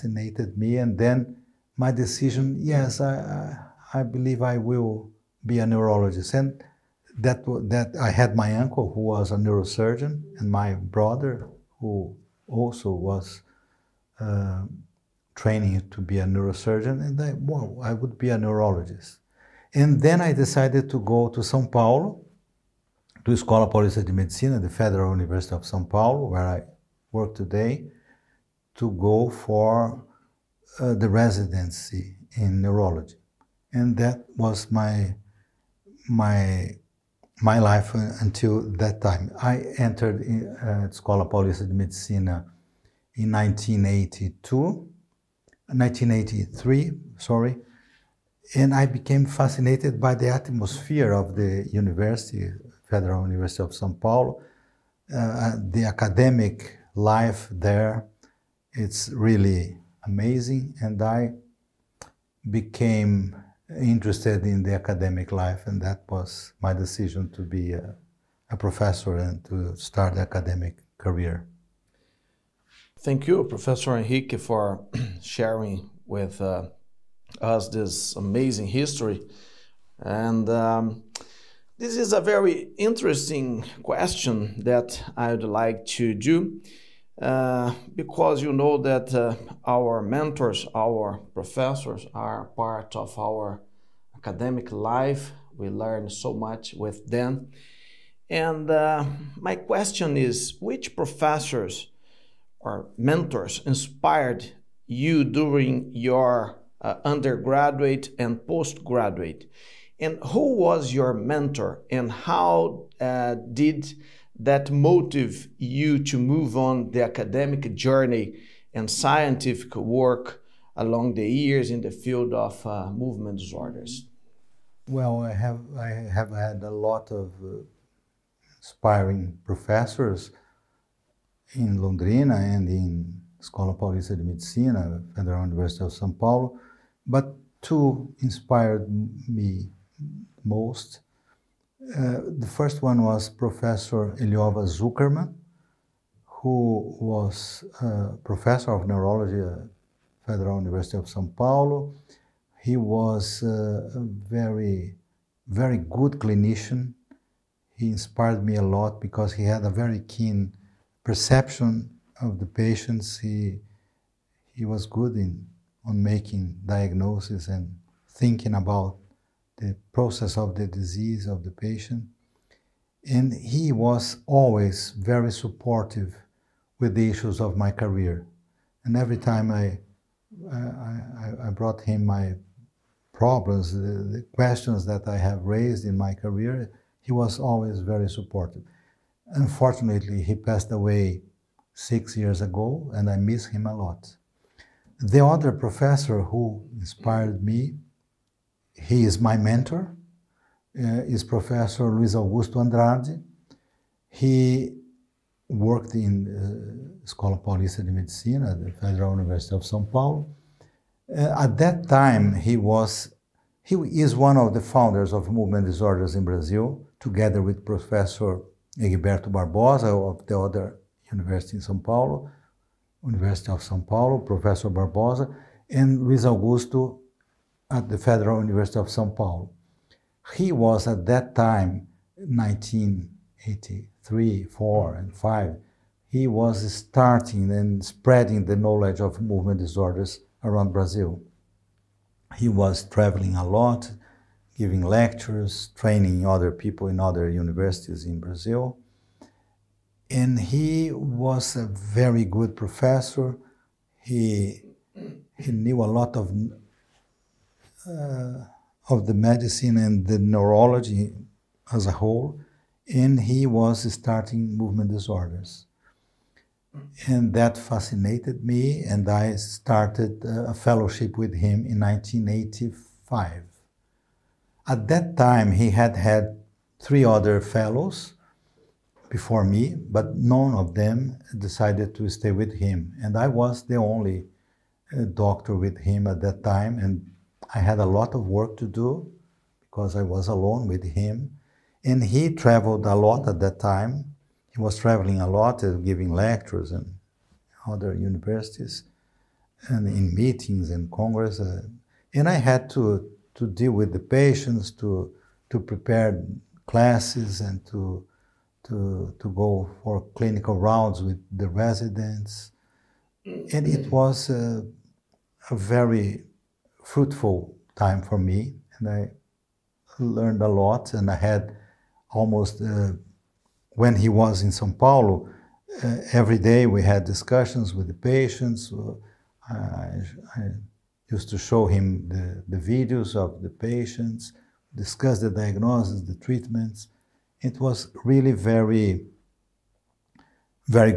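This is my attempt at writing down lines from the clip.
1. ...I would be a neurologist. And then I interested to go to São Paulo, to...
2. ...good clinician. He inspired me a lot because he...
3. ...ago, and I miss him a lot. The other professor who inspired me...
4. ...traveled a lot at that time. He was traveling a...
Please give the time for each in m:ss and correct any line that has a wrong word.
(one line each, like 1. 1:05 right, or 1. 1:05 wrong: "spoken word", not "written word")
1. 0:17 wrong: "decided", not "interested"
2. 2:35 right
3. 3:12 right
4. 4:52 right.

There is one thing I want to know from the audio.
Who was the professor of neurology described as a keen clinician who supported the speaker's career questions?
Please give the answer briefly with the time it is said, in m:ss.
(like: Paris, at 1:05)
Eliova Zukerman, at 2:24.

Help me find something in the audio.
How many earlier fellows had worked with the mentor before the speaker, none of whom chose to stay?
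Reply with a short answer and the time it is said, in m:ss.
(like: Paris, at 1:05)
3, at 4:36.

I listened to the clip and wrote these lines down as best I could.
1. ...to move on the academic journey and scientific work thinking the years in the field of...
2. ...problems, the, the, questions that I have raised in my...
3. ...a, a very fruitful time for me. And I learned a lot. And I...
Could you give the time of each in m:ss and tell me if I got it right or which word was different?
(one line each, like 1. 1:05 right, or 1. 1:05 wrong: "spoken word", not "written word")
1. 1:56 wrong: "along", not "thinking"
2. 3:03 right
3. 5:14 right.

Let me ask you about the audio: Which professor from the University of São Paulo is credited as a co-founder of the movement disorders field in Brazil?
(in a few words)
Egberto Barbosa.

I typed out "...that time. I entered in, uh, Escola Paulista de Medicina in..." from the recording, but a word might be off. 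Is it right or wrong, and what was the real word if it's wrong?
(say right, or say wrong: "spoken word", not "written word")
right.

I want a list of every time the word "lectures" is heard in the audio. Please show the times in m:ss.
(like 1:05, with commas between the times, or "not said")
4:04, 4:56.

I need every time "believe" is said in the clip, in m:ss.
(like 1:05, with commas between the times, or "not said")
0:04.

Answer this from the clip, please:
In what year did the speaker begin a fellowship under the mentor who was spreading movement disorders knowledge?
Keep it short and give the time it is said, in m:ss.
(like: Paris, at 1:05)
1985, at 4:31.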